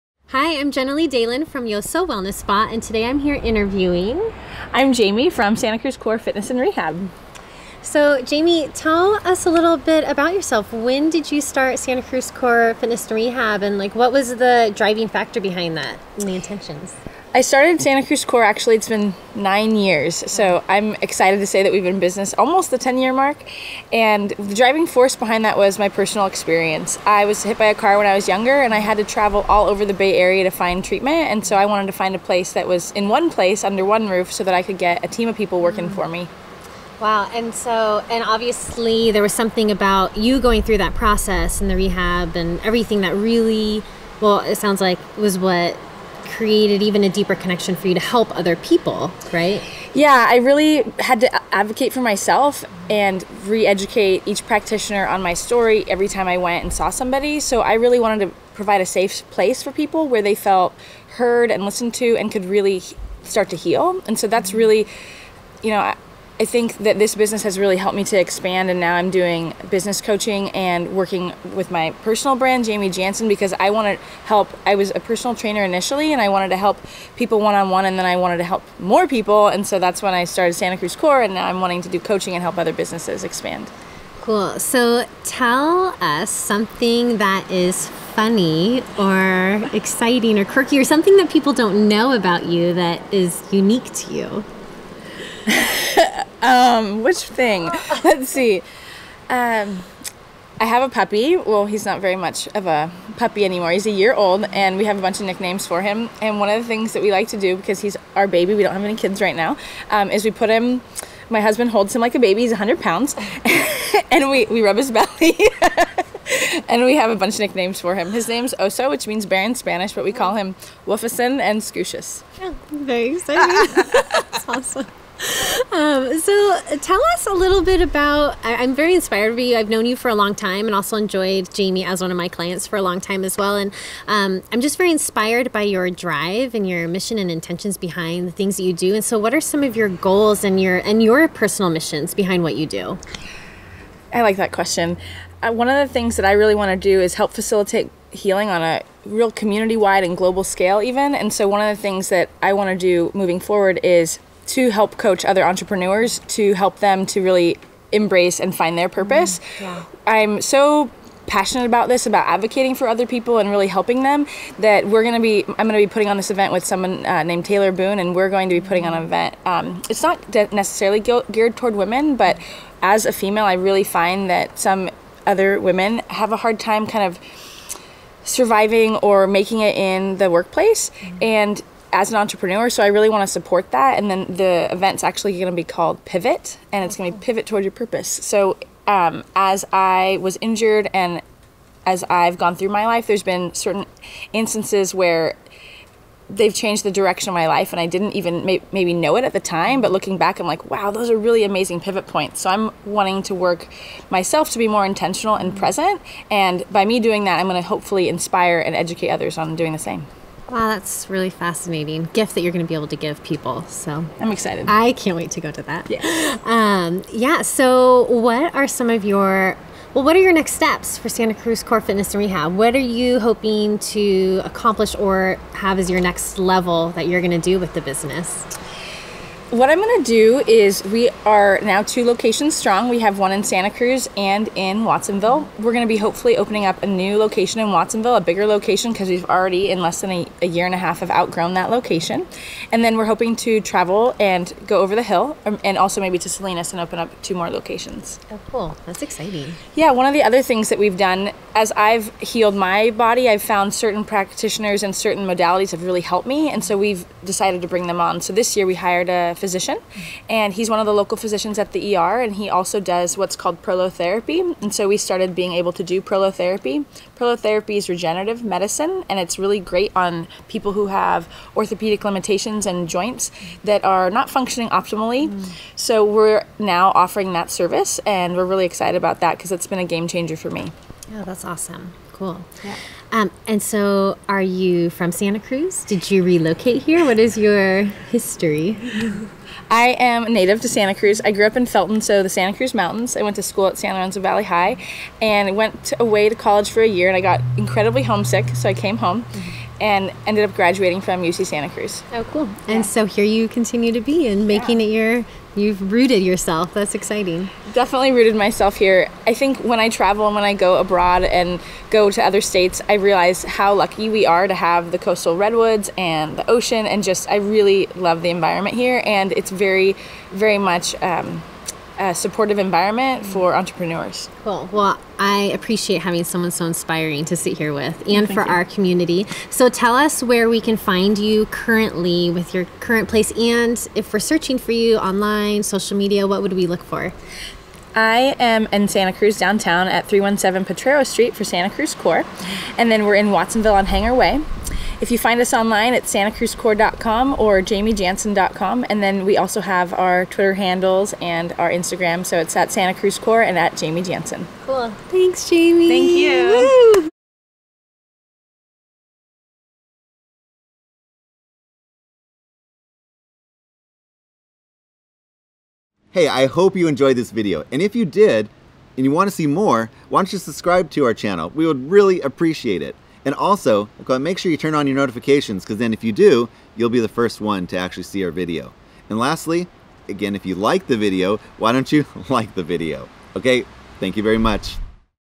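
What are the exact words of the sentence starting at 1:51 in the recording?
My husband holds him like a baby.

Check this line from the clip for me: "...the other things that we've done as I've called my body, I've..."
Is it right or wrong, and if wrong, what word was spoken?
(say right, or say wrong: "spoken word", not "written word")
wrong: "healed", not "called".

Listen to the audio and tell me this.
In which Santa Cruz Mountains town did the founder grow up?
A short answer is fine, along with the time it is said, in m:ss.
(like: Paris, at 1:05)
Felton, at 4:51.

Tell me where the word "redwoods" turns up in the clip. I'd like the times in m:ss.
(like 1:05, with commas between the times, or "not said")
5:15.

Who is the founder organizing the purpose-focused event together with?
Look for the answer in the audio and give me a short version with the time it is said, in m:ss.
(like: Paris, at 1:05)
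Taylor Boone, at 2:47.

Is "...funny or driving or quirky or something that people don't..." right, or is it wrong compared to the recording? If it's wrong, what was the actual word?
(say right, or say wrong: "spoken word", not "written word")
wrong: "exciting", not "driving".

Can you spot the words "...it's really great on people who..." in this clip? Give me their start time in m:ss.
4:29.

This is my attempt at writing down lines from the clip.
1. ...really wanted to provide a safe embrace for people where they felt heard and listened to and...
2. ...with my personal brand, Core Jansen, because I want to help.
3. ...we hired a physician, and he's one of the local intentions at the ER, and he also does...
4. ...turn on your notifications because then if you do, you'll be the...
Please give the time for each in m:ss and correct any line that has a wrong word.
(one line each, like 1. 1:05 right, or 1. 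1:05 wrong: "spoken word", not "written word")
1. 0:57 wrong: "place", not "embrace"
2. 1:11 wrong: "Jaimi", not "Core"
3. 4:18 wrong: "physicians", not "intentions"
4. 6:14 right.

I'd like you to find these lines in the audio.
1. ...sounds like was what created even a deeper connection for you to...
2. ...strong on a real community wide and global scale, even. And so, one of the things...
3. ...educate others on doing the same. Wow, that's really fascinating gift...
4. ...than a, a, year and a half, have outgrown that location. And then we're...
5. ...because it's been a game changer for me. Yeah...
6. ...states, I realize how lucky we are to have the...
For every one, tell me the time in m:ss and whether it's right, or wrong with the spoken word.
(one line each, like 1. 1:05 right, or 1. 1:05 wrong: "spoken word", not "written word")
1. 0:44 right
2. 2:28 wrong: "healing", not "strong"
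3. 3:28 right
4. 3:59 right
5. 4:39 right
6. 5:12 right.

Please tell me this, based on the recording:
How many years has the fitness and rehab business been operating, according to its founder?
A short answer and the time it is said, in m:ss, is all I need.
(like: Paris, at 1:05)
9, at 0:19.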